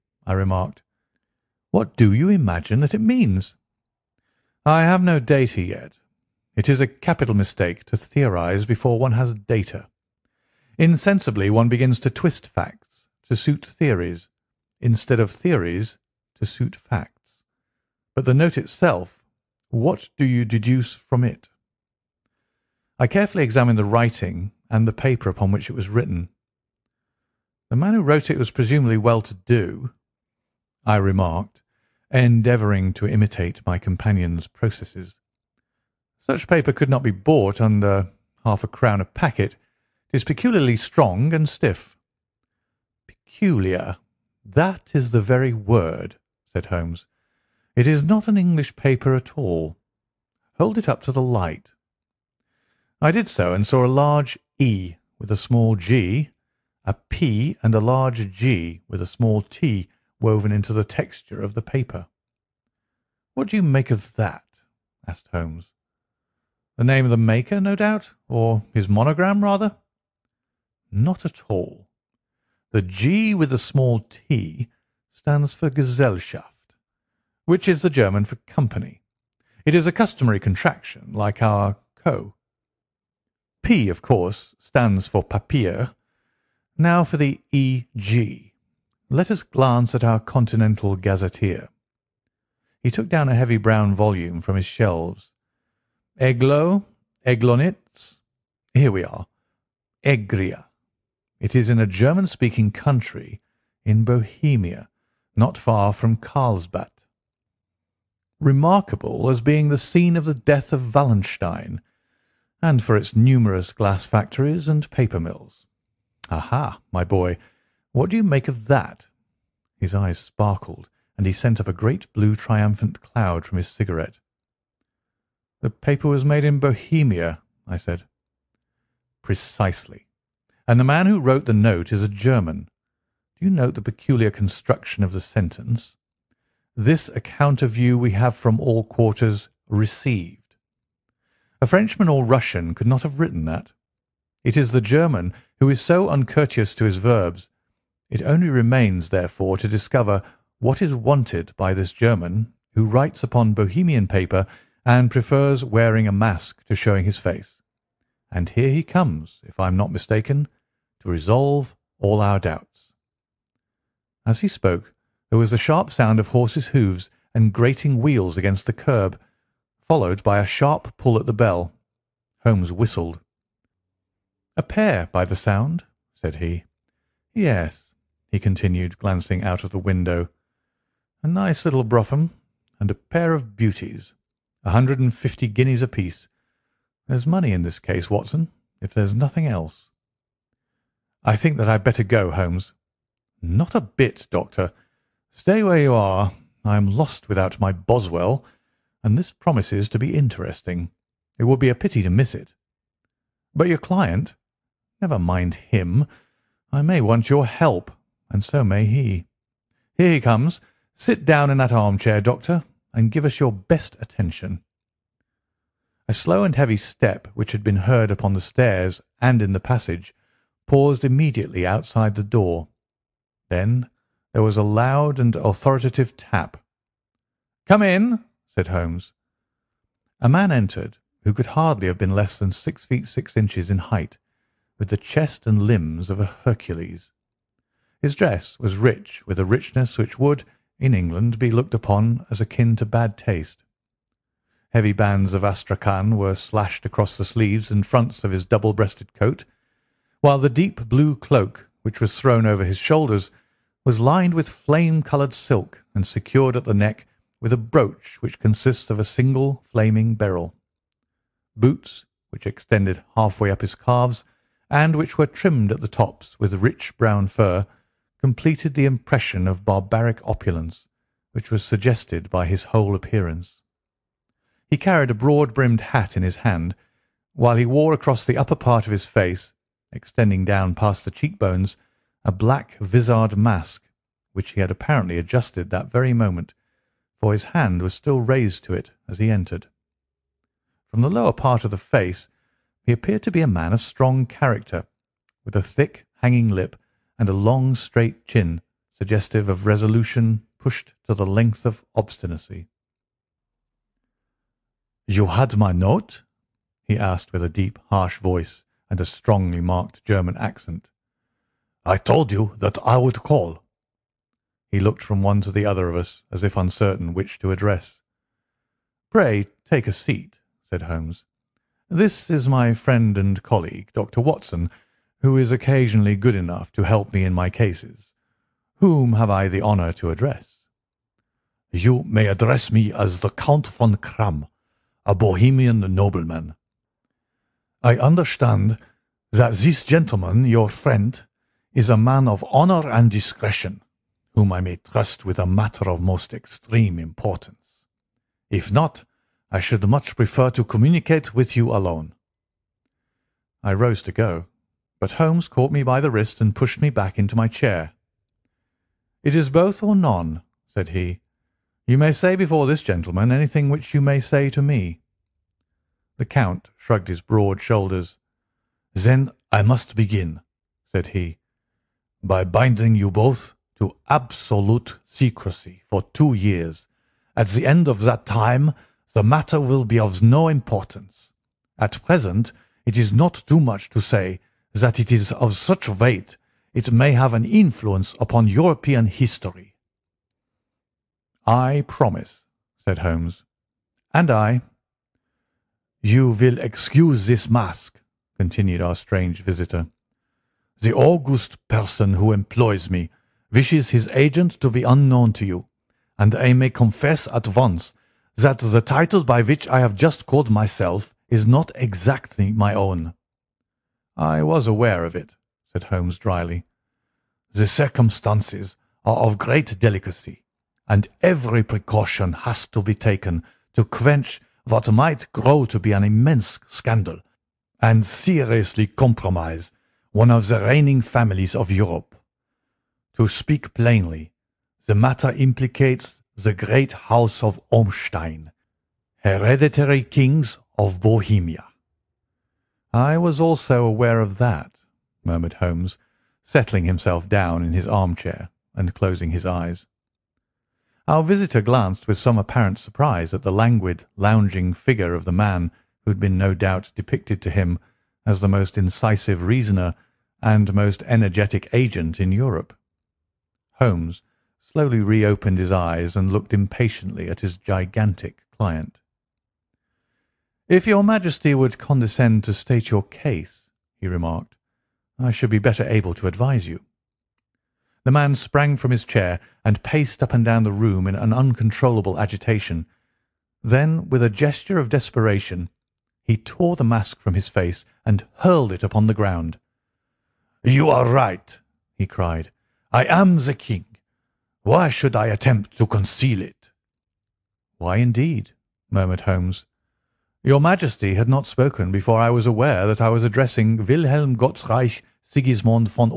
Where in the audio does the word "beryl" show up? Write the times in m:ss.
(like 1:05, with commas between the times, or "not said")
4:20.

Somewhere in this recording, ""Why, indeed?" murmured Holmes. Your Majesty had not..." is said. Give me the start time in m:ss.
8:17.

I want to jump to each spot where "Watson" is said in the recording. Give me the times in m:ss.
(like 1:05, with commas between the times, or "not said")
3:08, 5:24.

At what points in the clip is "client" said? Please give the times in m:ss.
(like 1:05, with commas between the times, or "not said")
3:23, 7:48.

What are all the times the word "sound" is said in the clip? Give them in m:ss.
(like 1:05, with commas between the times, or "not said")
2:45, 2:55.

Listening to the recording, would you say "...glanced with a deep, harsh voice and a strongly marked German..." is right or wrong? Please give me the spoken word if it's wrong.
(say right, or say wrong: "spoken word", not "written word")
wrong: "asked", not "glanced".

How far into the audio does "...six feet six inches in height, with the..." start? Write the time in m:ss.
3:52.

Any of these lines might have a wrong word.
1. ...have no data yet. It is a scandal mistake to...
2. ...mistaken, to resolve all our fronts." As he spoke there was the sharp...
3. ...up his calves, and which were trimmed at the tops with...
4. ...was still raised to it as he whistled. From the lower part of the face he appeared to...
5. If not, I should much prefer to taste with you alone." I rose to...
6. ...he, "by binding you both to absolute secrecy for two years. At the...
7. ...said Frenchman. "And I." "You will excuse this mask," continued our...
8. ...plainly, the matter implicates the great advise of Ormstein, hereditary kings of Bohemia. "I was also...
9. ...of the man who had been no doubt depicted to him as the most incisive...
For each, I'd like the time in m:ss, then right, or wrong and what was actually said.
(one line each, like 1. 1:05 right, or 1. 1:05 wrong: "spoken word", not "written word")
1. 0:04 wrong: "capital", not "scandal"
2. 2:39 wrong: "doubts", not "fronts"
3. 4:23 right
4. 4:47 wrong: "entered", not "whistled"
5. 5:48 wrong: "communicate", not "taste"
6. 6:11 right
7. 6:32 wrong: "Holmes", not "Frenchman"
8. 7:13 wrong: "house", not "advise"
9. 7:35 right.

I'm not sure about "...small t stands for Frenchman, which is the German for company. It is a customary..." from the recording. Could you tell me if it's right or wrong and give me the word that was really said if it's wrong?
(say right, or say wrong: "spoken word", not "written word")
wrong: "Gesellschaft", not "Frenchman".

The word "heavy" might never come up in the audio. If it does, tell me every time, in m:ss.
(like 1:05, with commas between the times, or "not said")
1:33, 3:36, 4:04.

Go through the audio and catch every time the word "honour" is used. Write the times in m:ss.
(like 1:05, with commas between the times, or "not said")
5:29, 5:42.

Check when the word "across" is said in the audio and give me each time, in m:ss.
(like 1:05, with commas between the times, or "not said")
4:06, 4:37.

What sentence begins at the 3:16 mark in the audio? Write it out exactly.
I am lost without my Boswell, and this promises to be interesting.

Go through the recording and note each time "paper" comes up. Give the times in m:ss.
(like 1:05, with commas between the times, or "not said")
0:24, 0:36, 0:48, 1:01, 1:54, 2:05, 2:34.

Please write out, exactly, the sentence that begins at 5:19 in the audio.
"Pray take a seat," said Holmes.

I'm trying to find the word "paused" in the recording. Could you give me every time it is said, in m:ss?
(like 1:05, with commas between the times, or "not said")
3:40.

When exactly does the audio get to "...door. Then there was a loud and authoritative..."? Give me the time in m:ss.
3:42.